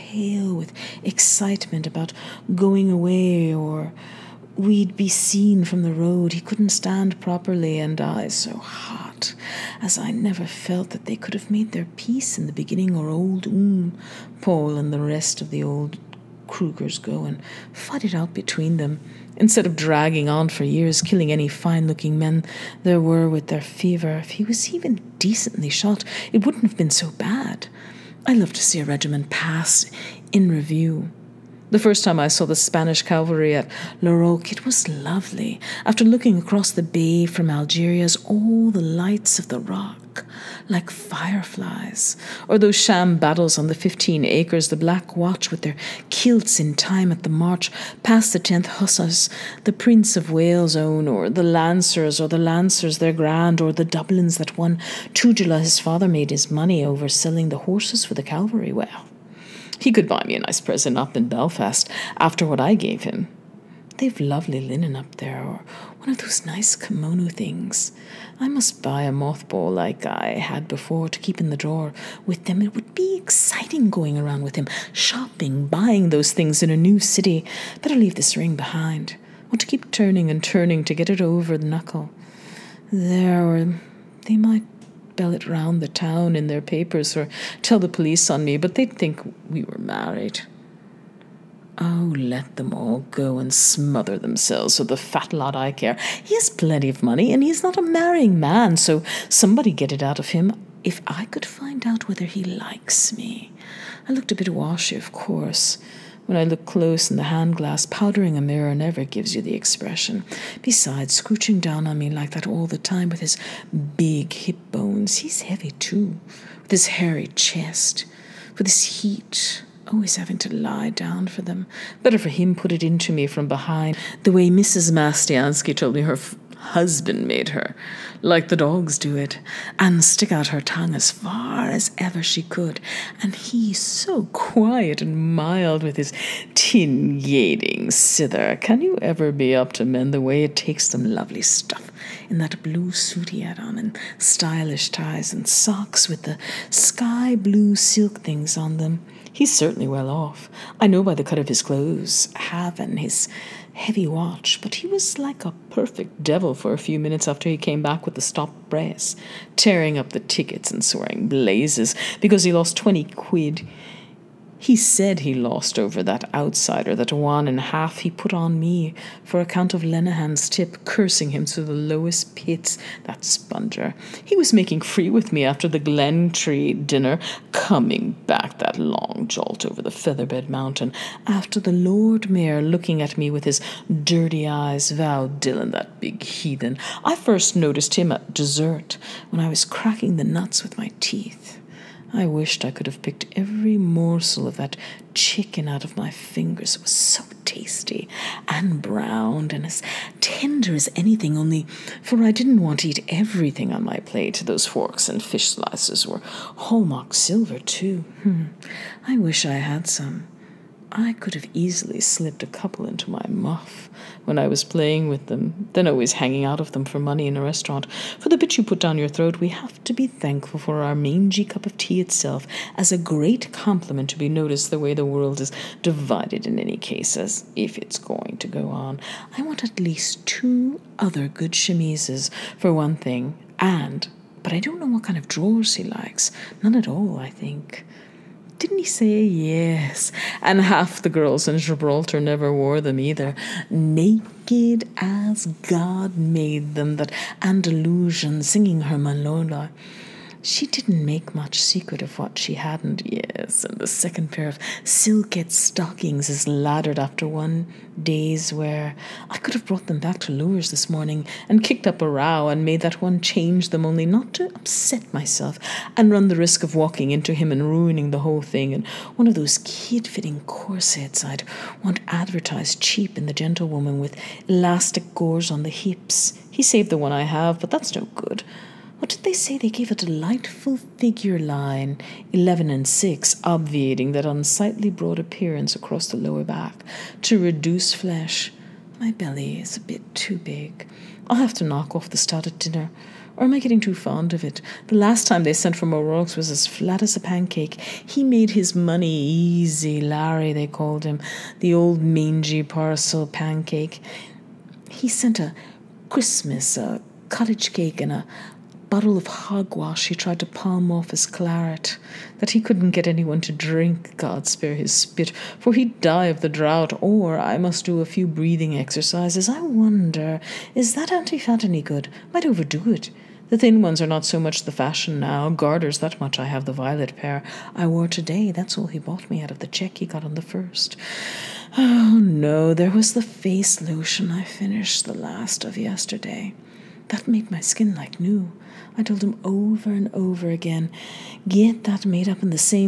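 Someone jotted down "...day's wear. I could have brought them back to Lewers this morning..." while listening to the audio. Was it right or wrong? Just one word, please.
right.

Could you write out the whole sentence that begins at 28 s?
I love to see a regiment pass in review.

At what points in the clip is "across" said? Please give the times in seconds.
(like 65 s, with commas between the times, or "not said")
36 s, 285 s.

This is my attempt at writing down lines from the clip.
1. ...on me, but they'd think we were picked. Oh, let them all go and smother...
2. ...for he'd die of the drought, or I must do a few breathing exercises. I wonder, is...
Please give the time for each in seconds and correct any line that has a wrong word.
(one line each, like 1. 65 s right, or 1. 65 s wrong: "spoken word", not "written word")
1. 88 s wrong: "married", not "picked"
2. 315 s right.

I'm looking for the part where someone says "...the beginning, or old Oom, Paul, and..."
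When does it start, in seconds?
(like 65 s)
12 s.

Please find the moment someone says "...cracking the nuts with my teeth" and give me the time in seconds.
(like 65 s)
189 s.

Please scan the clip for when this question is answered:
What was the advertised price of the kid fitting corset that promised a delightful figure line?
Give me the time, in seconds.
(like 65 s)
282 s.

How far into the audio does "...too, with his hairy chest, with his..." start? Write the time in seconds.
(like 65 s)
115 s.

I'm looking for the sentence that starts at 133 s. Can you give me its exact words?
And he so quiet and mild with his tin yading sither.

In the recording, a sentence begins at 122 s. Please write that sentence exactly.
Better for him put it into me from behind, the way Mrs.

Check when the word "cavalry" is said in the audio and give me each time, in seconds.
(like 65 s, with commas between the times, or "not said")
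33 s, 58 s.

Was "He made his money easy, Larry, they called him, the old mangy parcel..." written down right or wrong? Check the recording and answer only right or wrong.
right.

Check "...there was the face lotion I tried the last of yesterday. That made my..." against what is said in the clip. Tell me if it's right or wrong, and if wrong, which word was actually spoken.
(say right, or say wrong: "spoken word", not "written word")
wrong: "finished", not "tried".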